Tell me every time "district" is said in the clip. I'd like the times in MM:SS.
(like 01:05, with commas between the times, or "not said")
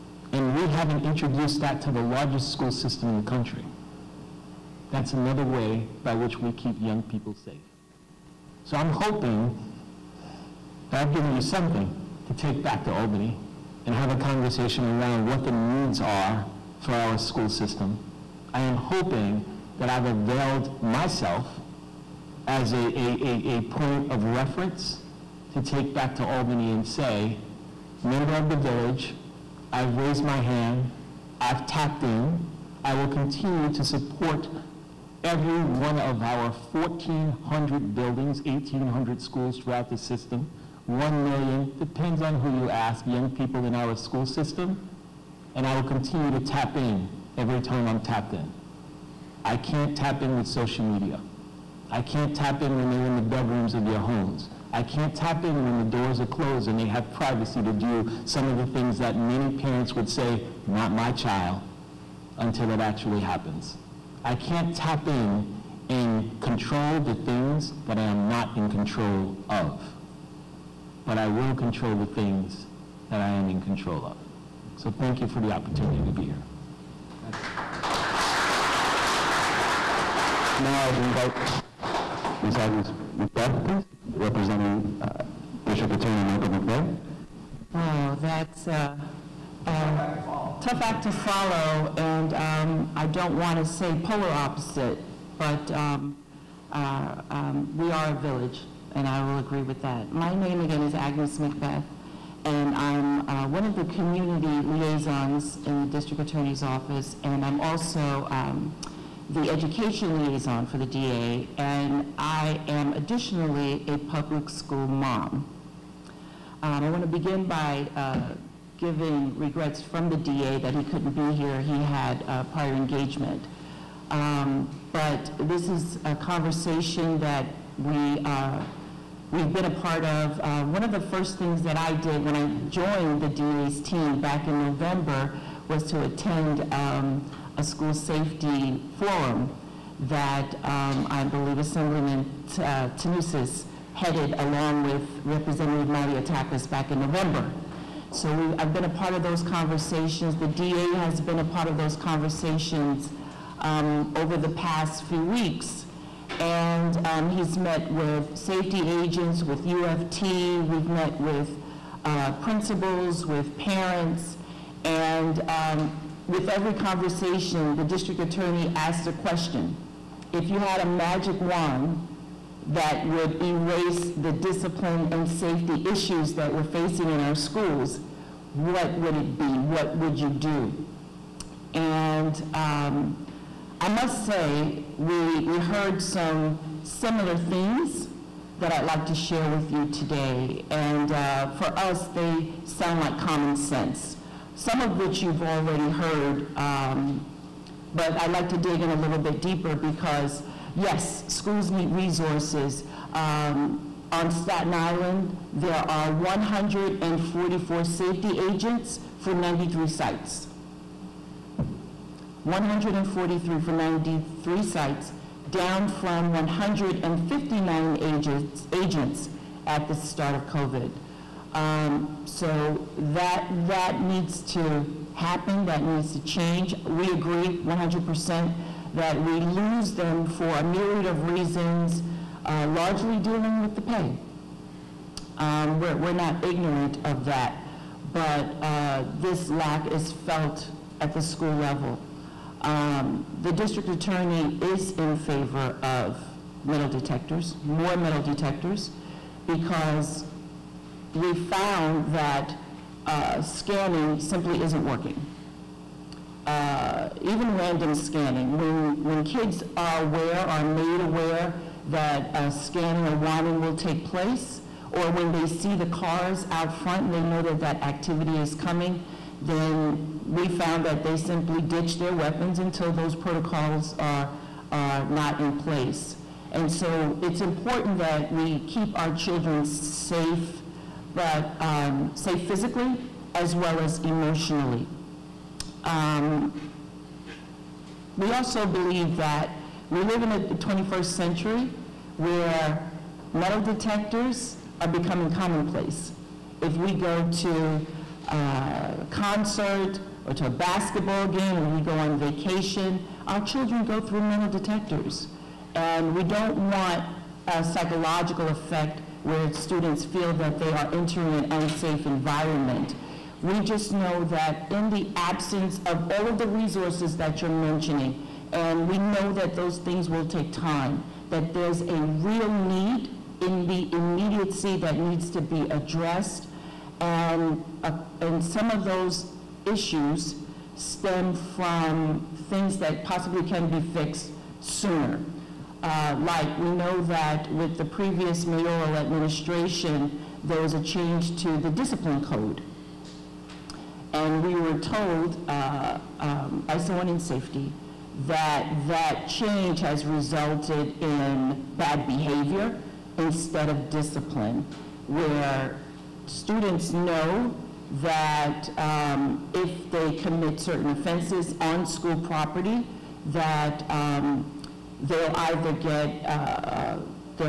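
01:25, 01:45, 02:47, 04:03.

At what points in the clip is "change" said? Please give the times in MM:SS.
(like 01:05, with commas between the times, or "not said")
03:46, 05:40, 05:49.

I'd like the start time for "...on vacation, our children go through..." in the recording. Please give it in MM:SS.
05:01.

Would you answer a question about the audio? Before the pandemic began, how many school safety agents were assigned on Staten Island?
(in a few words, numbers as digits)
159.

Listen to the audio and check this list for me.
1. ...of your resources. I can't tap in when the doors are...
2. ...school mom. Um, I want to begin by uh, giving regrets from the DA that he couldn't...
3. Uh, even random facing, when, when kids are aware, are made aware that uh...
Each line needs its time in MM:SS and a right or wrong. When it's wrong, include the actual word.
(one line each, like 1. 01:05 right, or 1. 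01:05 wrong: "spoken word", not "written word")
1. 00:53 wrong: "homes", not "resources"
2. 01:54 right
3. 04:16 wrong: "scanning", not "facing".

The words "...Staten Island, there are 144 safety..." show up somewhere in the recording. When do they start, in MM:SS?
03:24.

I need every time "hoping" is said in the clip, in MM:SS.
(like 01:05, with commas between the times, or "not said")
00:08, 00:18.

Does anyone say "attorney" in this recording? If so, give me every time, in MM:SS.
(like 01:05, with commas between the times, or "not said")
01:25, 01:46, 02:48, 04:03.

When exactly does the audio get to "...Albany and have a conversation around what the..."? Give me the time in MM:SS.
00:12.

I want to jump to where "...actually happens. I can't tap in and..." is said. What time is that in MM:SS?
01:02.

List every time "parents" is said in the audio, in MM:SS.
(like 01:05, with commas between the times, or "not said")
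00:59, 02:43.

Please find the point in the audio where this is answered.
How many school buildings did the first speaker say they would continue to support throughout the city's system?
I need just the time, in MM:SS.
00:36.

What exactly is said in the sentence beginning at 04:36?
And so it's important that we keep our children safe, but um, safe physically as well as emotionally.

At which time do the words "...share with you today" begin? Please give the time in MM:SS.
03:09.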